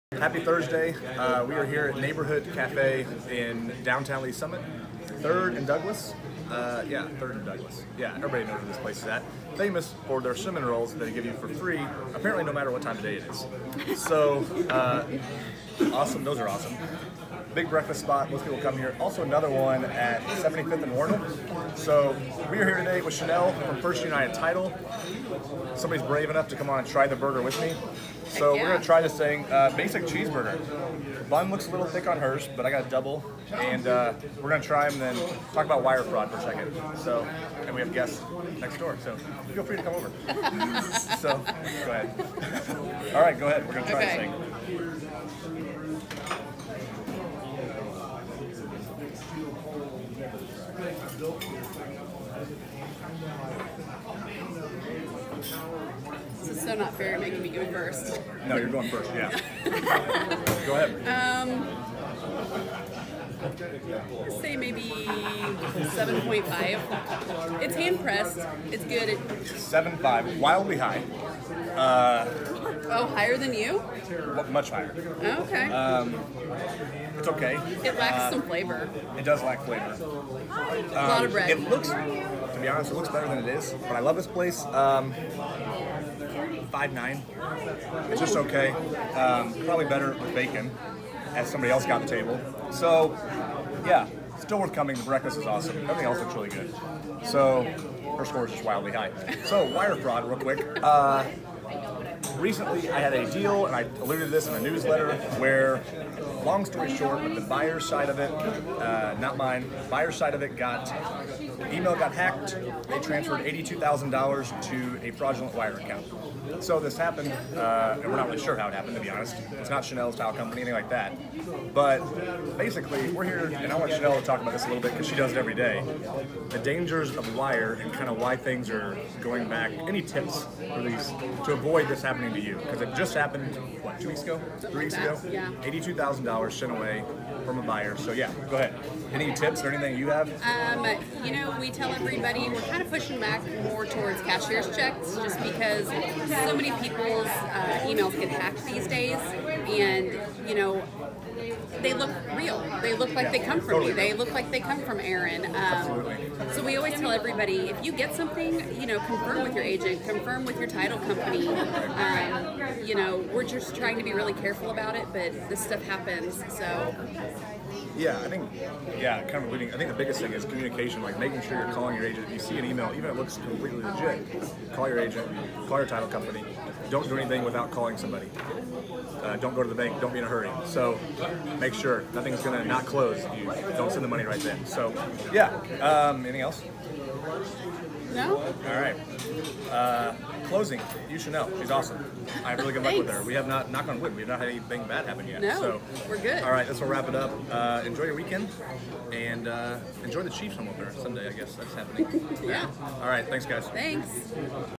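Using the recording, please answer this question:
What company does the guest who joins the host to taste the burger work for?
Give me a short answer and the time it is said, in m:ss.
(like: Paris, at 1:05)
First United Title, at 0:23.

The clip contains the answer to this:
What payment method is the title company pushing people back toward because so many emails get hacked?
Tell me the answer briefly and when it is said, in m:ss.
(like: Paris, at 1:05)
Cashier's checks, at 2:24.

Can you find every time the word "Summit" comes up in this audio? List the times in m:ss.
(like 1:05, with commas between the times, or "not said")
0:04.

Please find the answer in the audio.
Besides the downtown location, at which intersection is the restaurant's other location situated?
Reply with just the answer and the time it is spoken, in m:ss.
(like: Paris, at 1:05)
75th and Warner, at 0:20.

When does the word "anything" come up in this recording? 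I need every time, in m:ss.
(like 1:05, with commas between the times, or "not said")
2:00, 2:19, 2:57, 3:06, 3:14.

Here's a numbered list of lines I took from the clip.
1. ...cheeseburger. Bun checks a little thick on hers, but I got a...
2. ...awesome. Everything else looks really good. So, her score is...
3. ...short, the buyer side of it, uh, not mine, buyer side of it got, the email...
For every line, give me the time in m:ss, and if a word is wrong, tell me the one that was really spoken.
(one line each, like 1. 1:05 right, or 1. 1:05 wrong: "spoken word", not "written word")
1. 0:30 wrong: "looks", not "checks"
2. 1:35 right
3. 1:46 right.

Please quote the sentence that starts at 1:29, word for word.
Um, probably better with bacon, as somebody else got the table.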